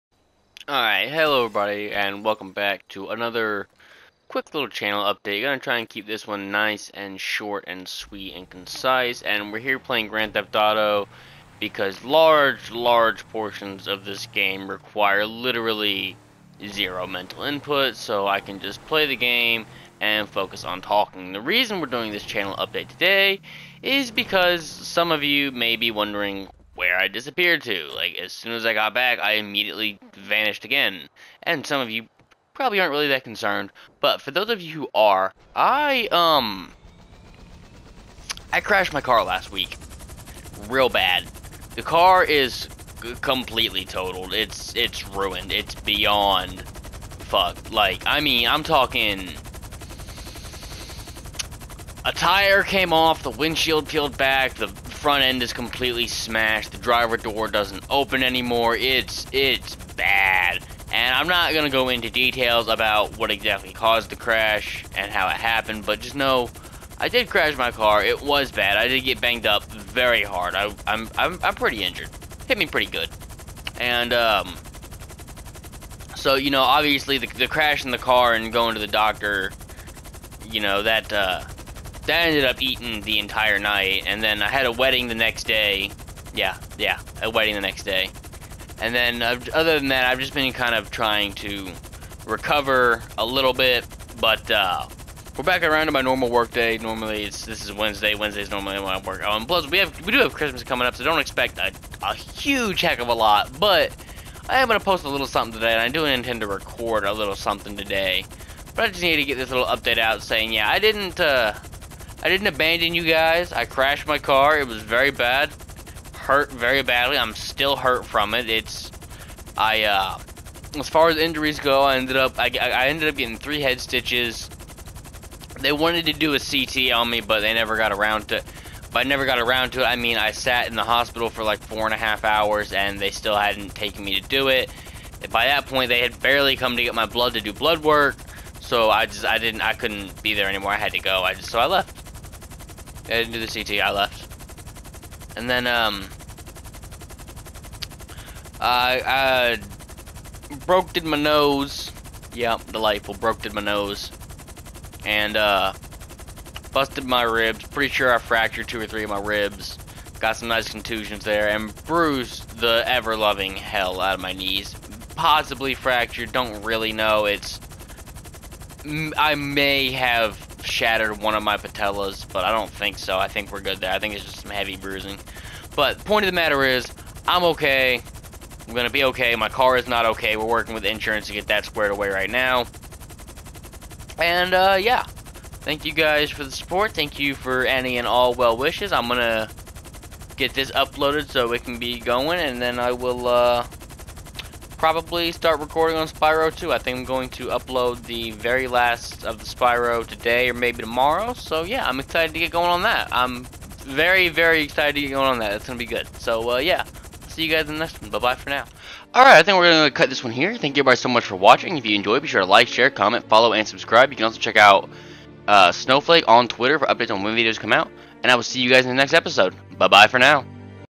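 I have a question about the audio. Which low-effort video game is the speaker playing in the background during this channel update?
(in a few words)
Grand Theft Auto.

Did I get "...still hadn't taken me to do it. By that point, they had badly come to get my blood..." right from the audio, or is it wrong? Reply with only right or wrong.
wrong.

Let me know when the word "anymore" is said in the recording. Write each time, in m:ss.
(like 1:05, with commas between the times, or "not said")
0:58, 2:20.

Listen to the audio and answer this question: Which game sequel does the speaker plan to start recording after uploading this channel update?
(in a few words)
Spyro 2.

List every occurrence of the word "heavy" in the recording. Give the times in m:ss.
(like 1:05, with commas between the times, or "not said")
2:54.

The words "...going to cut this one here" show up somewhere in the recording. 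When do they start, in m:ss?
3:29.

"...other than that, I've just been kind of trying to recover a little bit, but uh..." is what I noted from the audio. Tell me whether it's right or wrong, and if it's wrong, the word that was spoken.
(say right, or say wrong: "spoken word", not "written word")
right.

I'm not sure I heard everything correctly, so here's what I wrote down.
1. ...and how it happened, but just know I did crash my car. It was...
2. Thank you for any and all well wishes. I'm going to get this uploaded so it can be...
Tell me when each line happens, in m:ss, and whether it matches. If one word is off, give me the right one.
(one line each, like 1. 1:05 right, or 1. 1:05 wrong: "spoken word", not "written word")
1. 1:04 right
2. 3:06 right.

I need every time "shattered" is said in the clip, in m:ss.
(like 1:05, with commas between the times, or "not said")
2:50.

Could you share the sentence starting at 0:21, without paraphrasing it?
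The reason we're doing this channel update today is because some of you may be wondering where I disappeared to.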